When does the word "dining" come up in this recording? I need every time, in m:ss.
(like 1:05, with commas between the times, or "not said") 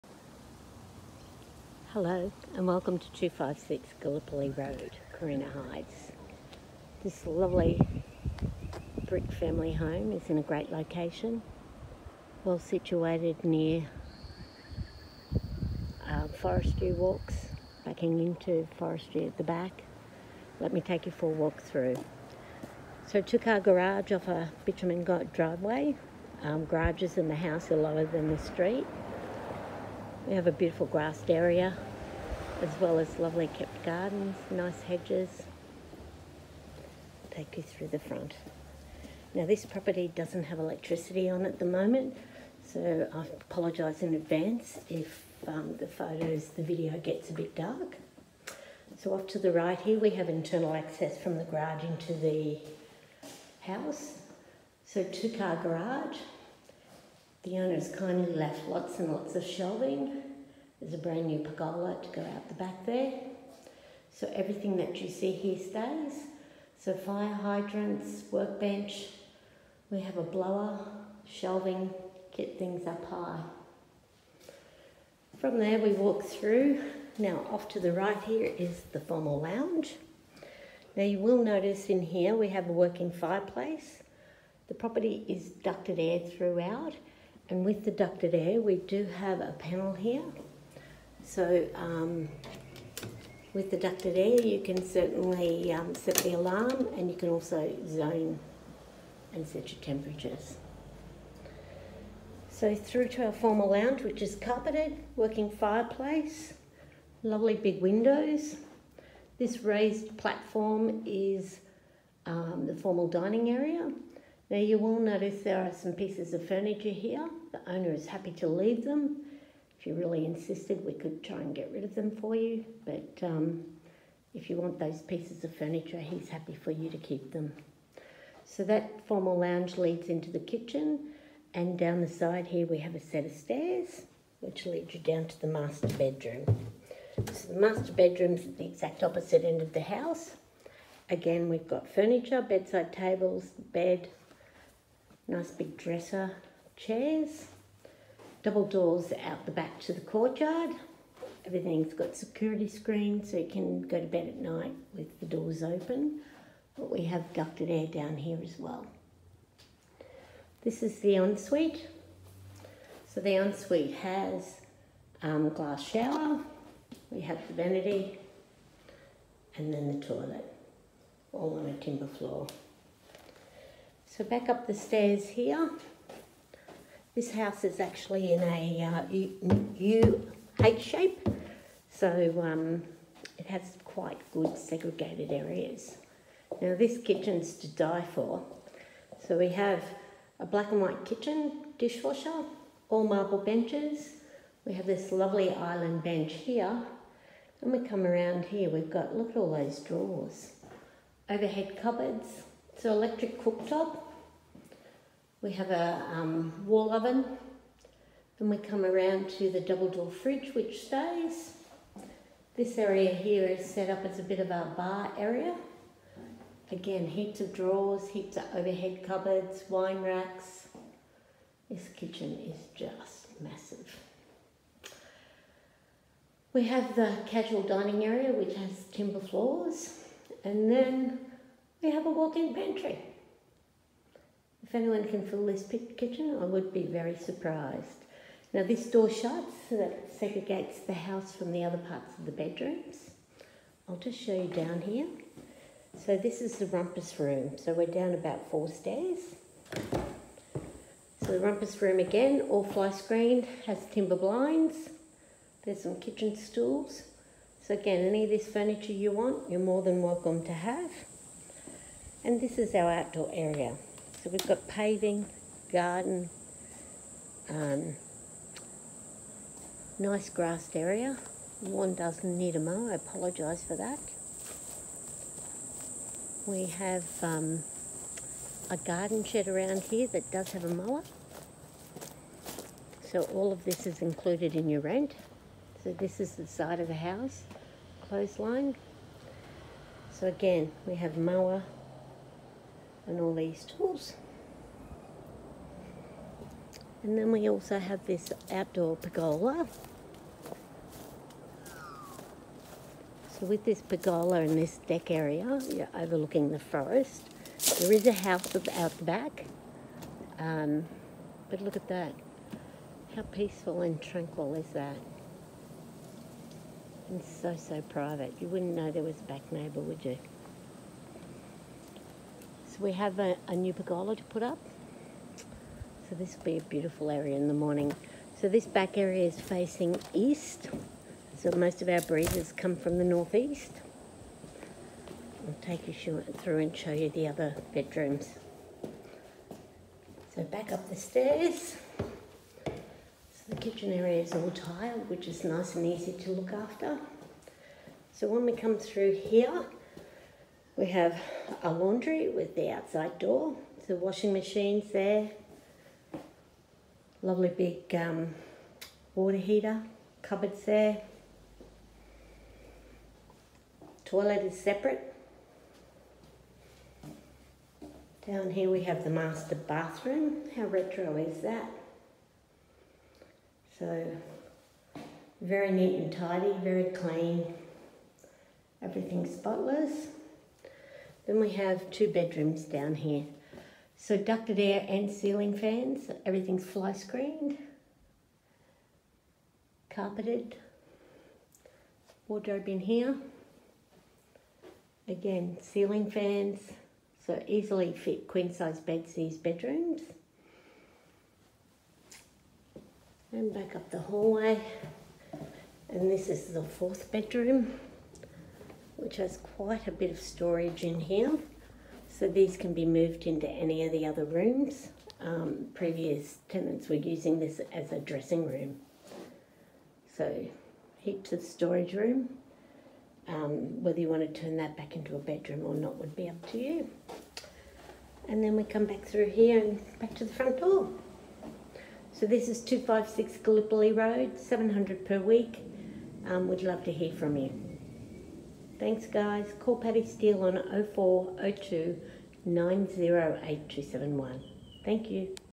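1:53, 3:47.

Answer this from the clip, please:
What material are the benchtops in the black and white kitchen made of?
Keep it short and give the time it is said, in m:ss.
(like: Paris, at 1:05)
marble, at 3:12.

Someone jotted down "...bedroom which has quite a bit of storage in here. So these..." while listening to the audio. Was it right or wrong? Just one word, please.
right.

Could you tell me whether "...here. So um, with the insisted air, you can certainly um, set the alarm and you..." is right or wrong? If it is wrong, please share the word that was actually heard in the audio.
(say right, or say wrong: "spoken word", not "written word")
wrong: "ducted", not "insisted".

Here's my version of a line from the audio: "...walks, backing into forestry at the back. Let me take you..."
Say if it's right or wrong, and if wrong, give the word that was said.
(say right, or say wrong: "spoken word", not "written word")
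right.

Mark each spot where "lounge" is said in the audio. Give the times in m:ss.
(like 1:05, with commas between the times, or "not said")
1:19, 1:43, 2:09.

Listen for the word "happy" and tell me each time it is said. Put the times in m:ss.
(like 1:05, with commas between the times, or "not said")
1:58, 2:06.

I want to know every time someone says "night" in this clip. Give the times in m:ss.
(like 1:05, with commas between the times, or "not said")
2:34.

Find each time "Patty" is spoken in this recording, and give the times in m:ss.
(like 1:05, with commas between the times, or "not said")
7:19.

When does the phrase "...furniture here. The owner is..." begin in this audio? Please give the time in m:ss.
1:56.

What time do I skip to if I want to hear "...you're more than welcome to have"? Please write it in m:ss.
4:19.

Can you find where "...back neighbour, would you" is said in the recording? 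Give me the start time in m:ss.
5:19.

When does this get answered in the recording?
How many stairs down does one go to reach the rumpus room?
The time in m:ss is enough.
4:08.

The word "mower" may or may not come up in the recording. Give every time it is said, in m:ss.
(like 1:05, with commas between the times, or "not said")
4:40, 4:51.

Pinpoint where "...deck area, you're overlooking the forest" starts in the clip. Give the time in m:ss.
5:04.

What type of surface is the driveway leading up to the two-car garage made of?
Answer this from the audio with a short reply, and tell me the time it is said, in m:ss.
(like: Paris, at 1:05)
bitumen, at 0:24.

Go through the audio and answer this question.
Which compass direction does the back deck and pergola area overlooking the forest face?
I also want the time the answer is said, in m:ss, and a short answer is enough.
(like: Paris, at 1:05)
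east, at 5:29.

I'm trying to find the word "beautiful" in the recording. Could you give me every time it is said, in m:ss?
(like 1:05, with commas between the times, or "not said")
0:30, 5:26.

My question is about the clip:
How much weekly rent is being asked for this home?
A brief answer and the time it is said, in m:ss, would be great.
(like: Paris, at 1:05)
700 per week, at 7:14.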